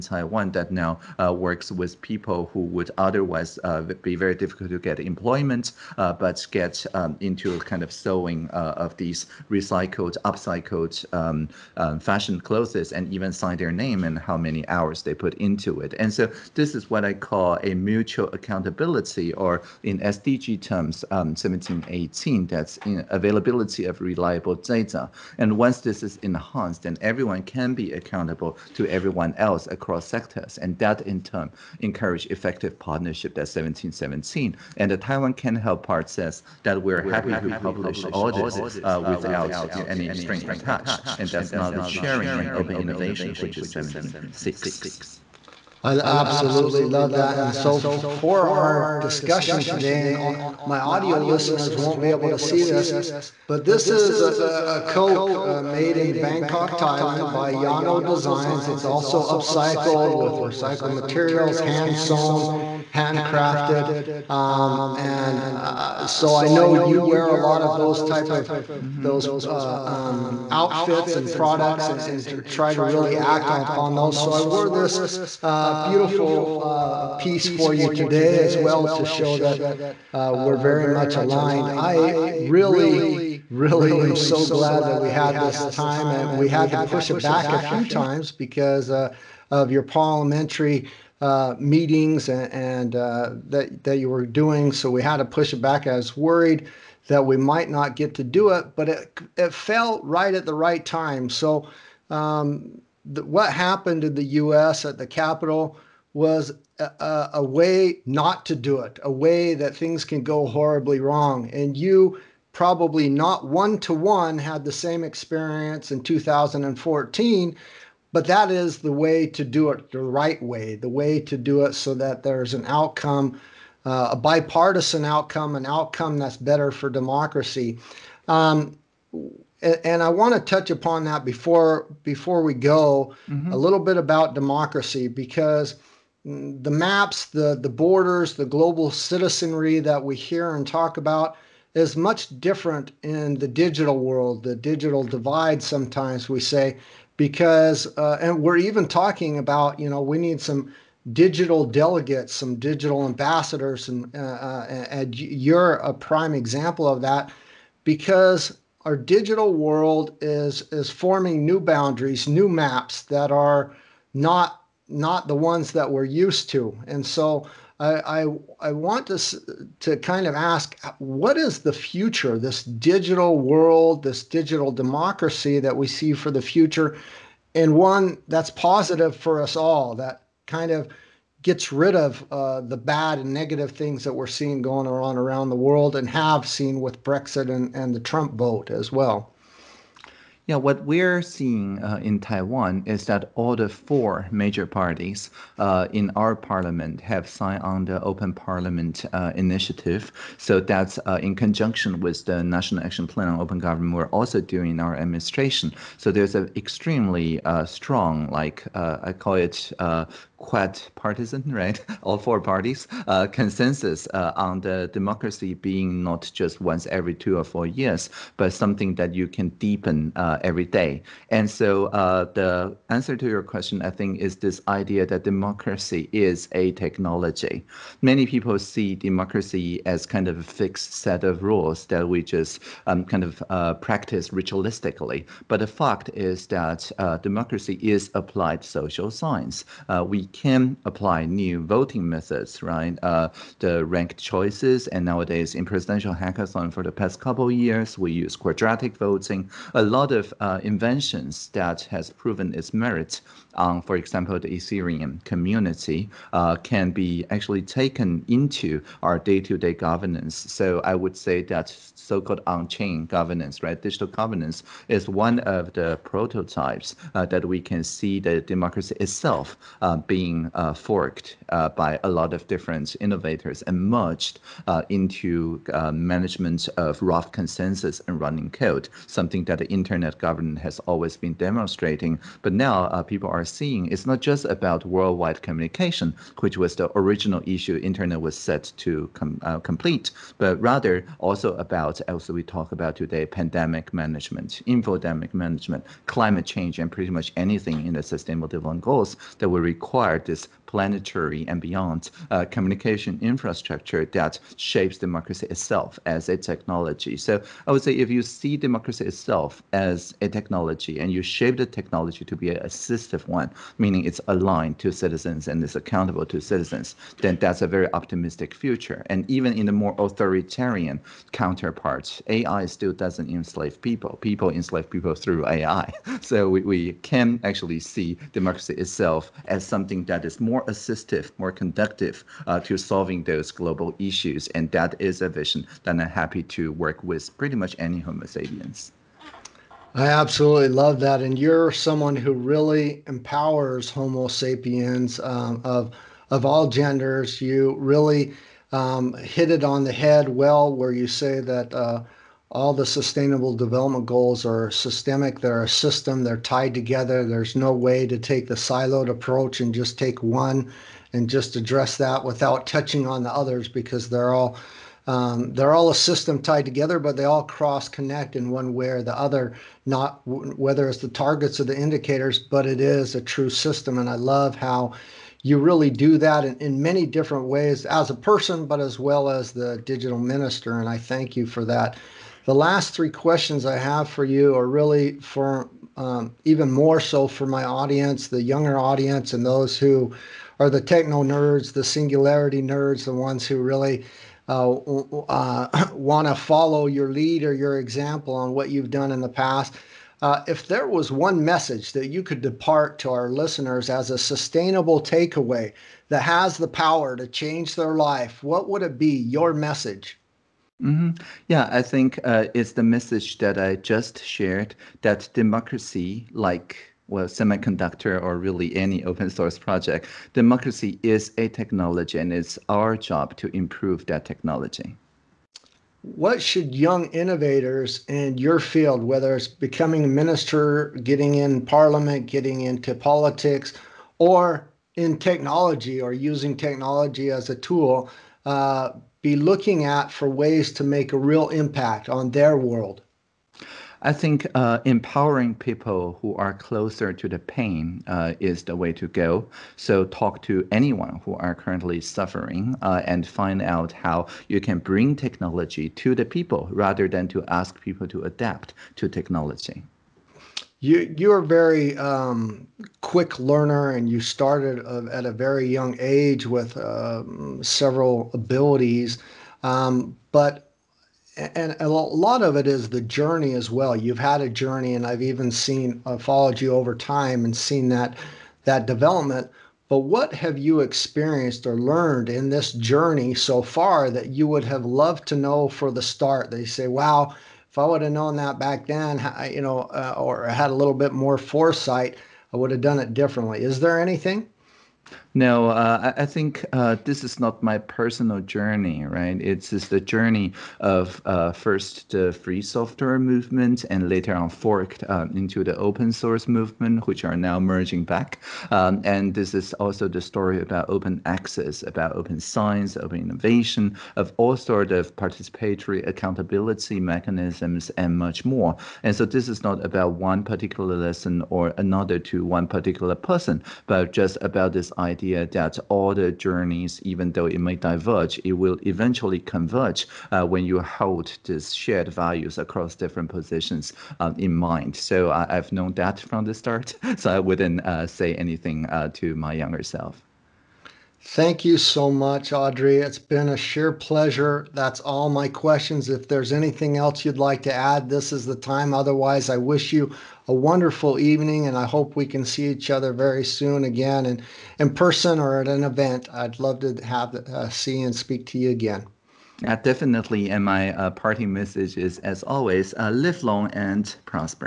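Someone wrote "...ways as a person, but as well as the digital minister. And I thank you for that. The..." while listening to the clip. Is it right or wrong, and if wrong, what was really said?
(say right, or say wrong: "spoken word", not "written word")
right.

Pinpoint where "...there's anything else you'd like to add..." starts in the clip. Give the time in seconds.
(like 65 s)
546 s.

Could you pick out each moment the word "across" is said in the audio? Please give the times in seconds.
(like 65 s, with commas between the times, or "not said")
29 s, 532 s.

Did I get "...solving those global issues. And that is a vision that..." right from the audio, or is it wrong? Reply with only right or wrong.
right.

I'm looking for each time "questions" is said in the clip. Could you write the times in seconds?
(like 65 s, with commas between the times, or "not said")
223 s, 383 s, 545 s.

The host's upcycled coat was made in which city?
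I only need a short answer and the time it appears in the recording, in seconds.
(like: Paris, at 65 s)
Bangkok, at 56 s.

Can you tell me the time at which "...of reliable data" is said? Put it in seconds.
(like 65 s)
23 s.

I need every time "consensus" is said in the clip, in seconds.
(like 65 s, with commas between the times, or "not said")
213 s, 277 s.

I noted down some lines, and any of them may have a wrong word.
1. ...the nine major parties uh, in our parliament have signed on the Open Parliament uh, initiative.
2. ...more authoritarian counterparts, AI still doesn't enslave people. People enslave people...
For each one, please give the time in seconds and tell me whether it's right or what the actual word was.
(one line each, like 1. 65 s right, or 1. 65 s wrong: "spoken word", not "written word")
1. 193 s wrong: "four", not "nine"
2. 319 s right.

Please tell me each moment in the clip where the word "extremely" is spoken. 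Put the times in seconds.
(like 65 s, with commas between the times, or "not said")
206 s.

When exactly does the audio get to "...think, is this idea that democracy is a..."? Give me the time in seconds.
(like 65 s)
223 s.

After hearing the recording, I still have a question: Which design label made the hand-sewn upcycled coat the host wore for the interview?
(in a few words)
Yano Designs.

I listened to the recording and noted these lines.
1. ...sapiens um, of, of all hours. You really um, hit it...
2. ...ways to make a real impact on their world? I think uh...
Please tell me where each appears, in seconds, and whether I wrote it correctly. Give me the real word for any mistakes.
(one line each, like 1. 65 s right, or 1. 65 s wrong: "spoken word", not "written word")
1. 344 s wrong: "genders", not "hours"
2. 440 s right.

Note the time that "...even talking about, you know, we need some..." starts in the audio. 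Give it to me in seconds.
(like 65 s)
148 s.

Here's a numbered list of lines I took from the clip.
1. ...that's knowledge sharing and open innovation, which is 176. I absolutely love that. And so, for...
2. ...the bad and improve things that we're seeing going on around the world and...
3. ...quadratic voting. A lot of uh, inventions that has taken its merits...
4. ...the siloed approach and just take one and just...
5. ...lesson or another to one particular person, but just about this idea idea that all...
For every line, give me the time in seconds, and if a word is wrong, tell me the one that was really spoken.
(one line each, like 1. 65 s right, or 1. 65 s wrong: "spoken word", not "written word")
1. 41 s right
2. 182 s wrong: "negative", not "improve"
3. 248 s wrong: "proven", not "taken"
4. 358 s right
5. 520 s right.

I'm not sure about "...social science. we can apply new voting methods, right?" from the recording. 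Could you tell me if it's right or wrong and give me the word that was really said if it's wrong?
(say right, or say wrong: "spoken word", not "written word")
right.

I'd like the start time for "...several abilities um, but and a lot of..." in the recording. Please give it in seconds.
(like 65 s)
467 s.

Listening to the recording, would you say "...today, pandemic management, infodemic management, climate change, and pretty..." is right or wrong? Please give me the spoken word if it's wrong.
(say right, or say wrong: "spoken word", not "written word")
right.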